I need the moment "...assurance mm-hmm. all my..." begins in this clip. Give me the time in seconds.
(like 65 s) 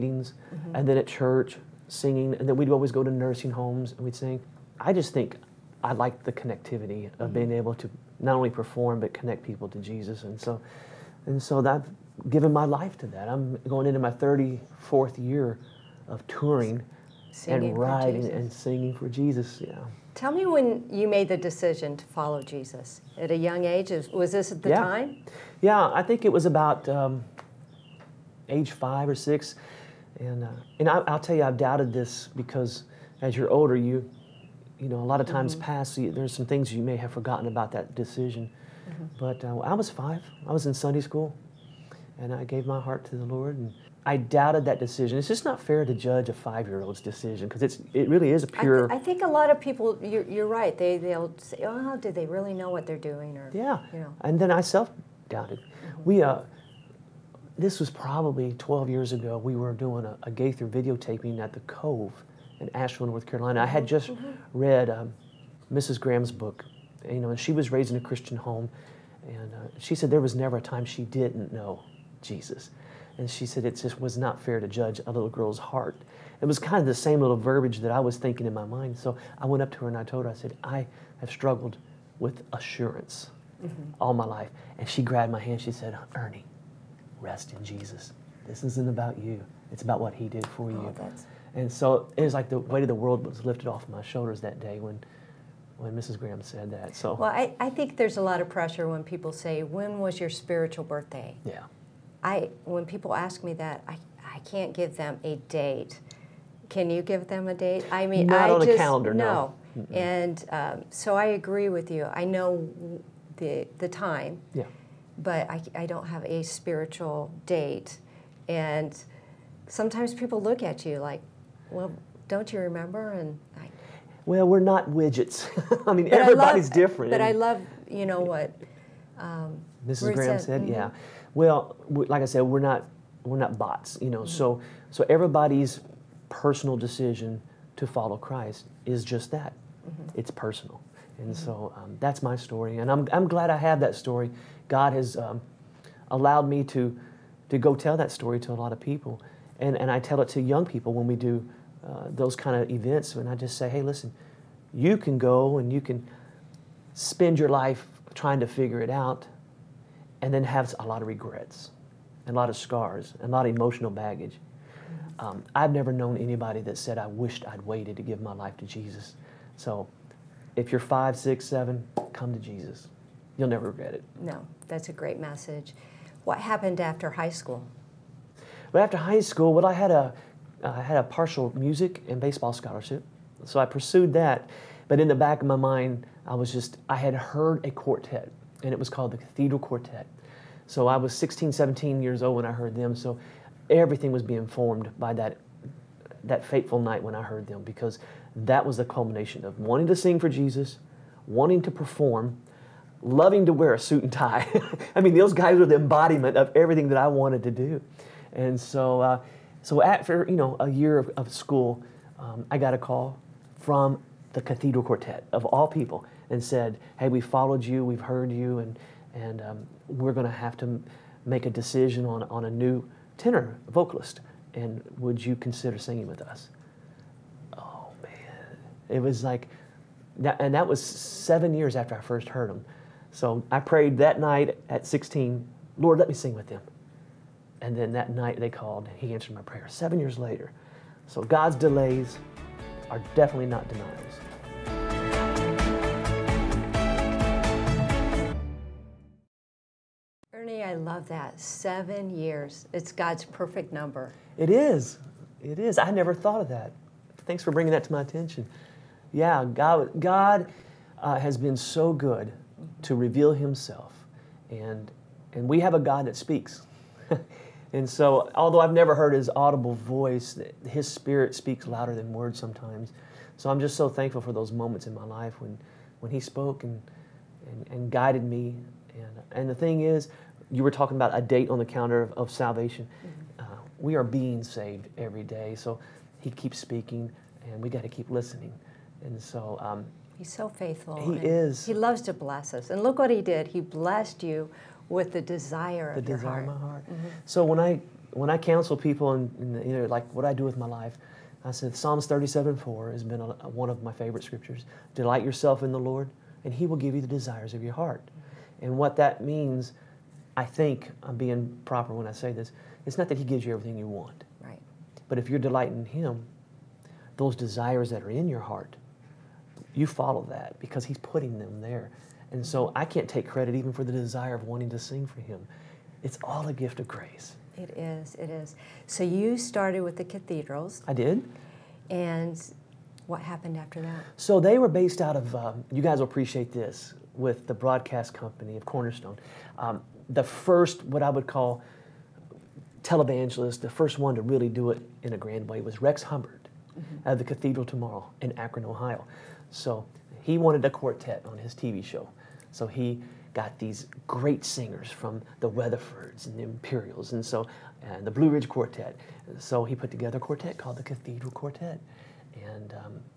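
82 s.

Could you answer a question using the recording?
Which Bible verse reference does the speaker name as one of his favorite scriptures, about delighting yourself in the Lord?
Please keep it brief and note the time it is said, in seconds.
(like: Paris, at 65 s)
Psalms 37:4, at 301 s.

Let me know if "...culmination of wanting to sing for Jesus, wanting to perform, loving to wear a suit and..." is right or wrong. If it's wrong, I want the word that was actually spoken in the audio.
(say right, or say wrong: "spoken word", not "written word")
right.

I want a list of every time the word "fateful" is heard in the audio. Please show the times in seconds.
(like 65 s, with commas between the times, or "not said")
196 s.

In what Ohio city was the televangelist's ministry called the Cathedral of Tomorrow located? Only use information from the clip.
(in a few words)
Akron.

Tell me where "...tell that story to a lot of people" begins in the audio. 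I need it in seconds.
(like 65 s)
147 s.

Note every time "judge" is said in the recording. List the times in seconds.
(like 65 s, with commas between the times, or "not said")
45 s, 74 s.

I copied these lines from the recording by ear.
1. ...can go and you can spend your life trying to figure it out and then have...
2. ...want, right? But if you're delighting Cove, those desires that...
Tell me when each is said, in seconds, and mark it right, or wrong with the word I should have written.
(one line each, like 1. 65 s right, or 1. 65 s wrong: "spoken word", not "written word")
1. 154 s right
2. 314 s wrong: "Him", not "Cove".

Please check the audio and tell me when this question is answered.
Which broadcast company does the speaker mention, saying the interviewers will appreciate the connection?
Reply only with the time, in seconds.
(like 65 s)
338 s.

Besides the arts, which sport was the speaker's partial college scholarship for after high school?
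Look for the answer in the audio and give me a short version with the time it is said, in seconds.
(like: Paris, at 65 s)
Baseball, at 182 s.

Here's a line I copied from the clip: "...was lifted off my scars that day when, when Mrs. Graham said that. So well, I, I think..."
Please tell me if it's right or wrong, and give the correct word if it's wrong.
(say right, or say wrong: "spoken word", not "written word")
wrong: "shoulders", not "scars".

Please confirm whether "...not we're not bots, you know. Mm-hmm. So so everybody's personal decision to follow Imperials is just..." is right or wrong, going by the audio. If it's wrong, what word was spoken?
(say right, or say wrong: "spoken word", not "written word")
wrong: "Christ", not "Imperials".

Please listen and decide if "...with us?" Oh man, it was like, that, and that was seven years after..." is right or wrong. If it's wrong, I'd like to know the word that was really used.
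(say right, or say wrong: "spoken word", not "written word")
right.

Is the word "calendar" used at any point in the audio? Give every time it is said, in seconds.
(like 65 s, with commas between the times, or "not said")
108 s, 281 s.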